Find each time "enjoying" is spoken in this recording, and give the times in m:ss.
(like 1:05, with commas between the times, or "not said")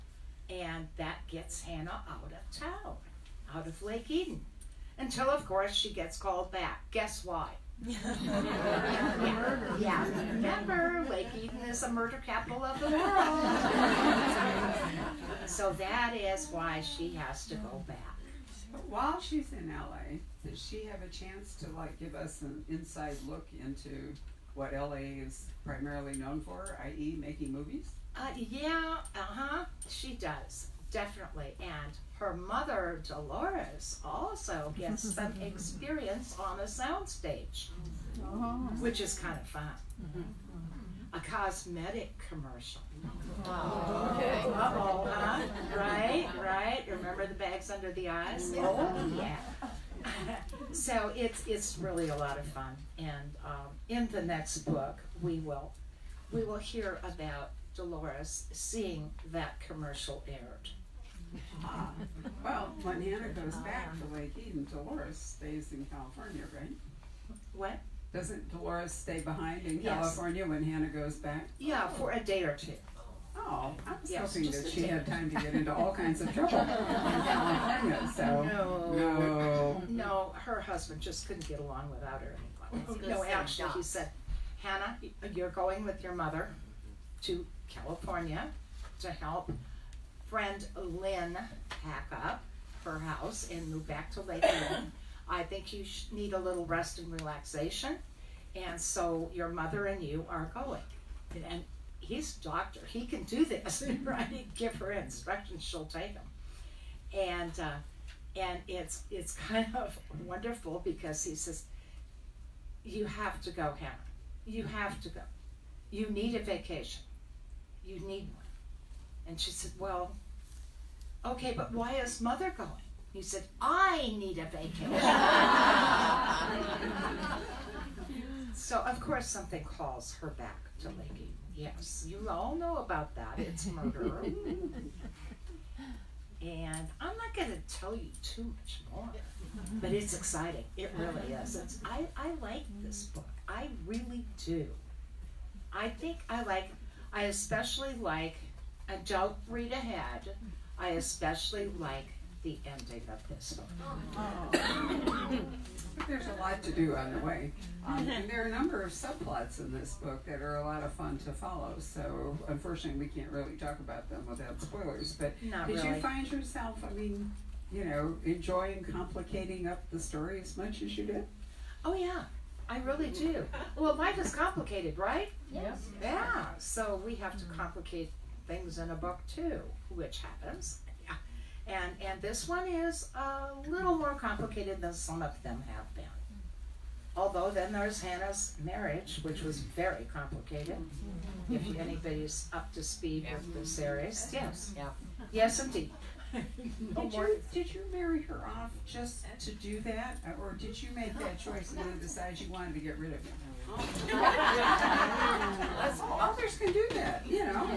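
2:48.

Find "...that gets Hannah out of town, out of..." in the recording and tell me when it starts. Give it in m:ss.
0:00.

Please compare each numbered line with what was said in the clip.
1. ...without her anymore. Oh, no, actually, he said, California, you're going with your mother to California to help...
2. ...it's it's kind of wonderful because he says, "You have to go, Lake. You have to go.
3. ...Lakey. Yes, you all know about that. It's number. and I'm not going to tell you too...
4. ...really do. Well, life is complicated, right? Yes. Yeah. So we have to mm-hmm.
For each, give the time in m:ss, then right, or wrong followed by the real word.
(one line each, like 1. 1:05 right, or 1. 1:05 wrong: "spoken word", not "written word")
1. 1:21 wrong: "Hannah", not "California"
2. 1:48 wrong: "Hannah", not "Lake"
3. 2:10 wrong: "murder", not "number"
4. 2:52 right.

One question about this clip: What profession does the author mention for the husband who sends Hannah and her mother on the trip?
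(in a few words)
Doctor.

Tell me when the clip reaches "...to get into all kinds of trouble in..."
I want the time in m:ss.
1:15.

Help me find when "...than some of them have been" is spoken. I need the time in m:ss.
3:04.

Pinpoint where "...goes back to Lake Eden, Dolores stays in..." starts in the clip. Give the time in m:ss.
1:03.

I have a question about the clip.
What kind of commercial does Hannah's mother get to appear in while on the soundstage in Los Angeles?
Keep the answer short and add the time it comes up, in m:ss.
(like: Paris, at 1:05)
A cosmetic commercial, at 0:41.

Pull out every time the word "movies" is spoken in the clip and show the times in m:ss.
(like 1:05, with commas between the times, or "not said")
0:27.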